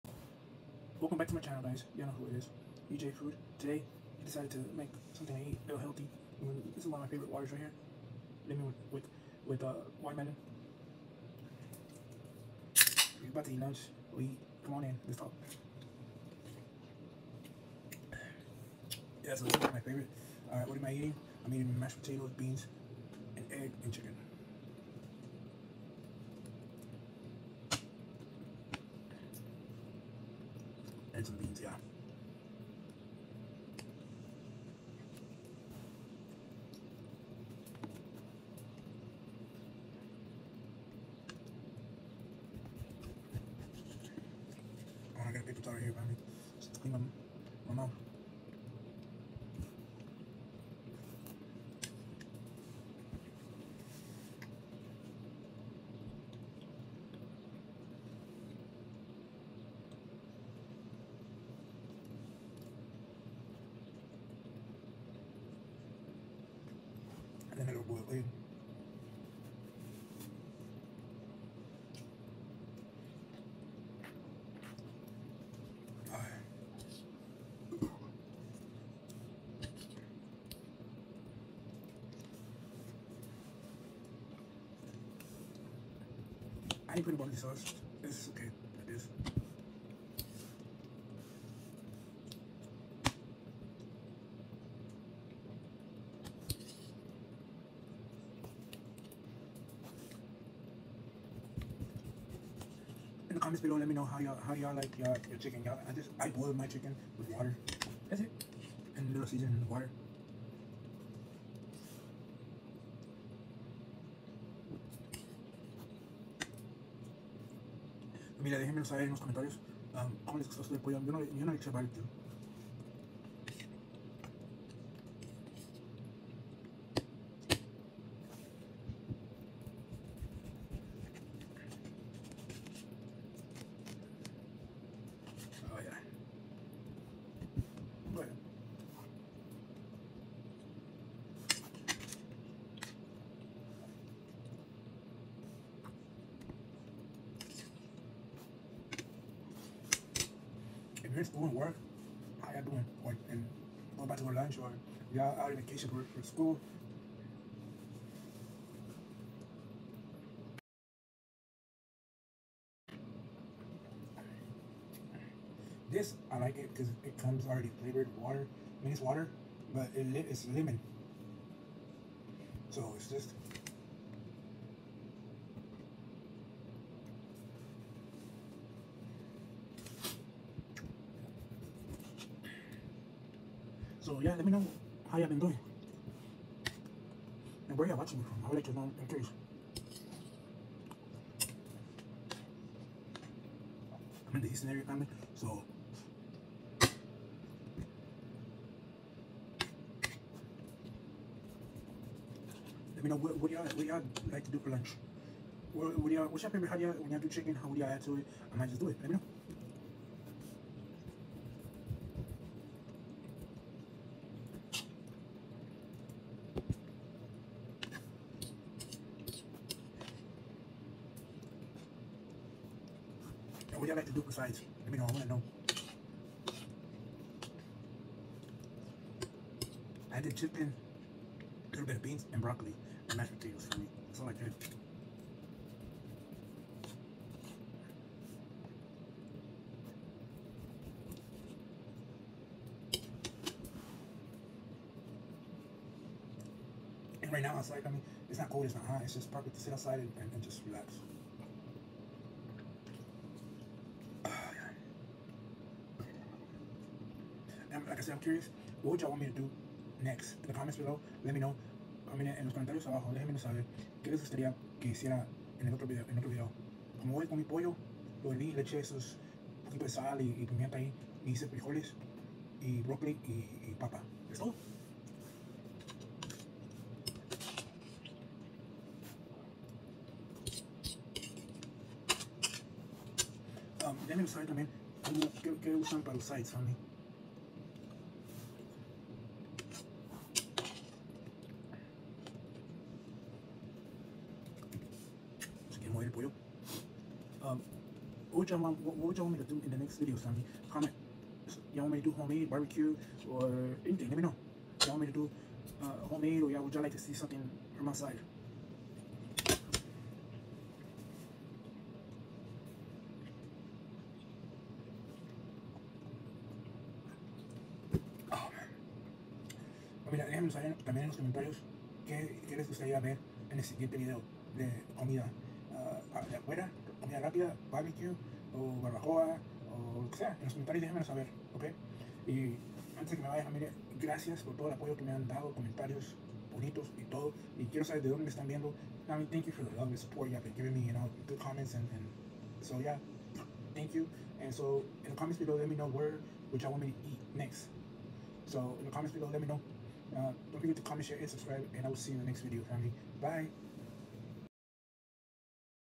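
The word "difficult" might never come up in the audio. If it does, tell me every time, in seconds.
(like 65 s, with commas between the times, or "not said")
not said.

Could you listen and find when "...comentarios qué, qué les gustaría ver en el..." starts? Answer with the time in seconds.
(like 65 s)
321 s.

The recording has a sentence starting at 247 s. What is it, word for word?
And right now outside, I mean, it's not cold, it's not hot, it's just perfect to sit outside and, and just relax.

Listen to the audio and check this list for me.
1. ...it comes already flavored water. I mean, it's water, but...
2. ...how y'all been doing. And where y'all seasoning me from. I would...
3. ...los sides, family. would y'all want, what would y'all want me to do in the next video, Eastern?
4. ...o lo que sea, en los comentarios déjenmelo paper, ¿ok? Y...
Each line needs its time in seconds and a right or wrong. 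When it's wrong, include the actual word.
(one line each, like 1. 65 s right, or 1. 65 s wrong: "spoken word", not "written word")
1. 167 s right
2. 185 s wrong: "watching", not "seasoning"
3. 286 s wrong: "Sammy", not "Eastern"
4. 329 s wrong: "saber", not "paper".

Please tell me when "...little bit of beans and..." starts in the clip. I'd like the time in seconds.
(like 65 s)
231 s.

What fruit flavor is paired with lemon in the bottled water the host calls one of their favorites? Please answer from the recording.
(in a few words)
Watermelon.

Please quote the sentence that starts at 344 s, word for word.
And so in the comments below, let me know where, which I want me to eat next.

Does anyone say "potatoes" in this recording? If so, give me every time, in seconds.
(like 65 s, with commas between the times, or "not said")
21 s, 233 s.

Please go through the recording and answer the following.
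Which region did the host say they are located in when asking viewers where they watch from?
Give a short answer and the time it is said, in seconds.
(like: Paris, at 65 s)
Eastern area, at 194 s.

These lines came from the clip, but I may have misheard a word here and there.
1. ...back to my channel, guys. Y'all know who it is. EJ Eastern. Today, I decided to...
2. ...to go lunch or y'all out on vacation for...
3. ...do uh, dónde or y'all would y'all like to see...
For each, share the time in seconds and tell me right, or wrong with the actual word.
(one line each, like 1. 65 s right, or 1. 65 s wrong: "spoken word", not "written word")
1. 1 s wrong: "Food", not "Eastern"
2. 154 s right
3. 305 s wrong: "homemade", not "dónde".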